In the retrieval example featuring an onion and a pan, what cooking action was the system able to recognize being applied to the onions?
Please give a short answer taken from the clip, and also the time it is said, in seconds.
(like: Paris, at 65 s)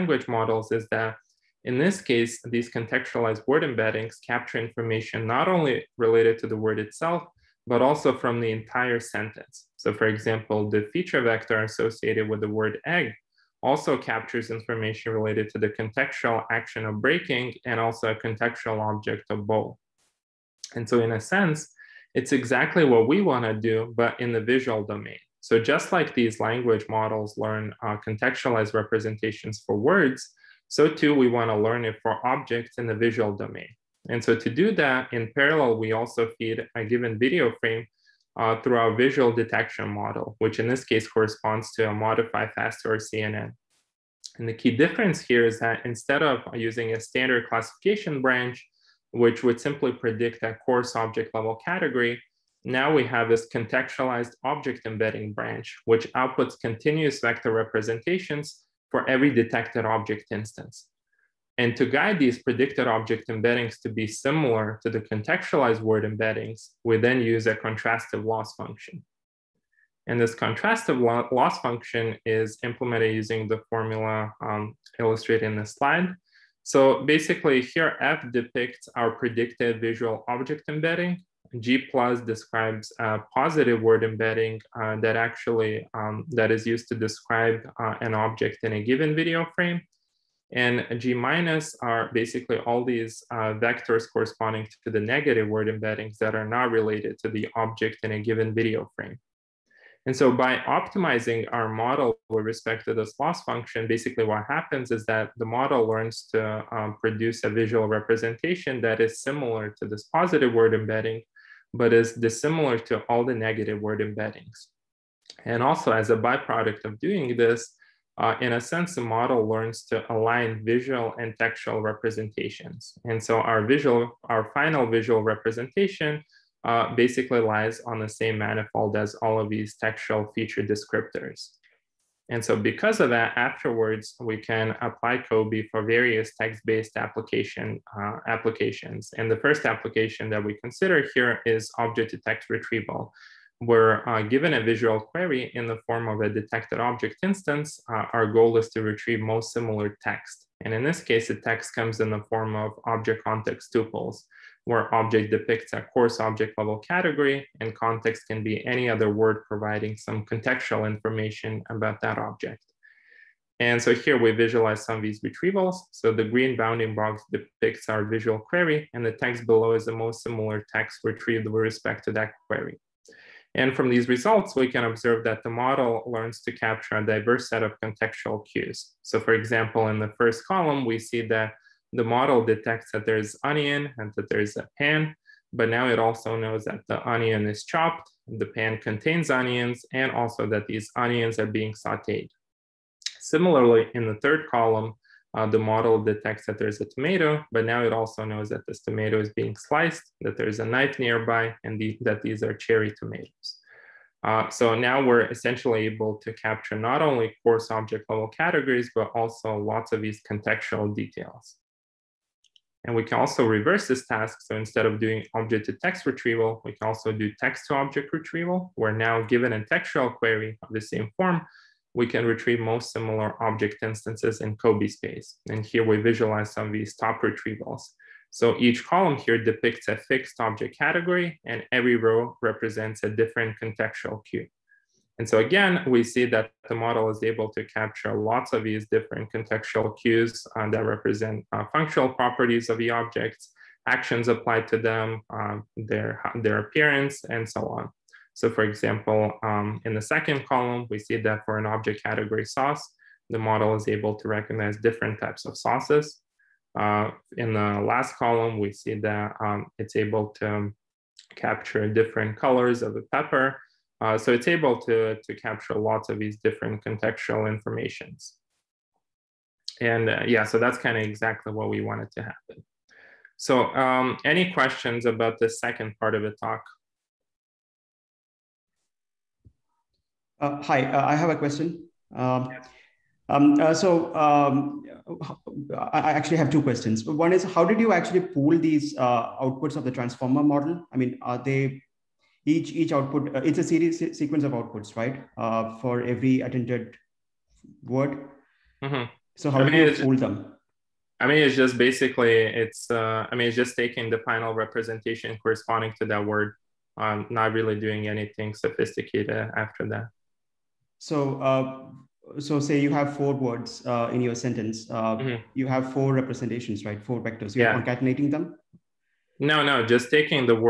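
Sauteed, at 191 s.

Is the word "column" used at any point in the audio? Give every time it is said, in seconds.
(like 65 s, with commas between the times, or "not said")
180 s, 194 s, 228 s, 250 s, 258 s.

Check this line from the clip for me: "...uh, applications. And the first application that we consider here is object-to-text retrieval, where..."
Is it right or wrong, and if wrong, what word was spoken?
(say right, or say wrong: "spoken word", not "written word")
right.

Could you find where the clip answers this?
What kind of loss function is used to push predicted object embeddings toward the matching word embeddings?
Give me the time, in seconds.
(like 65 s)
67 s.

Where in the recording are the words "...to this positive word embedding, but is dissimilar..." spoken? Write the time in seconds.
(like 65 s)
109 s.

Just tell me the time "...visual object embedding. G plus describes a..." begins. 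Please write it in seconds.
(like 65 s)
79 s.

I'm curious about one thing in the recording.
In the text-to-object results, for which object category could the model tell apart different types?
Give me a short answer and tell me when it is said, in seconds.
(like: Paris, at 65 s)
Sauce, at 252 s.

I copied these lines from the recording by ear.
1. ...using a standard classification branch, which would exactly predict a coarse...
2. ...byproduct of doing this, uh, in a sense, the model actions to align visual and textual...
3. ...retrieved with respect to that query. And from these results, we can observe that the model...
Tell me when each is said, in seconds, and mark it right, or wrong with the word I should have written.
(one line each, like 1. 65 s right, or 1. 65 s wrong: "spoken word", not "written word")
1. 46 s wrong: "simply", not "exactly"
2. 116 s wrong: "learns", not "actions"
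3. 171 s right.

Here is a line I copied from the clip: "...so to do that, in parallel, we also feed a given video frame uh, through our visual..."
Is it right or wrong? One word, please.
right.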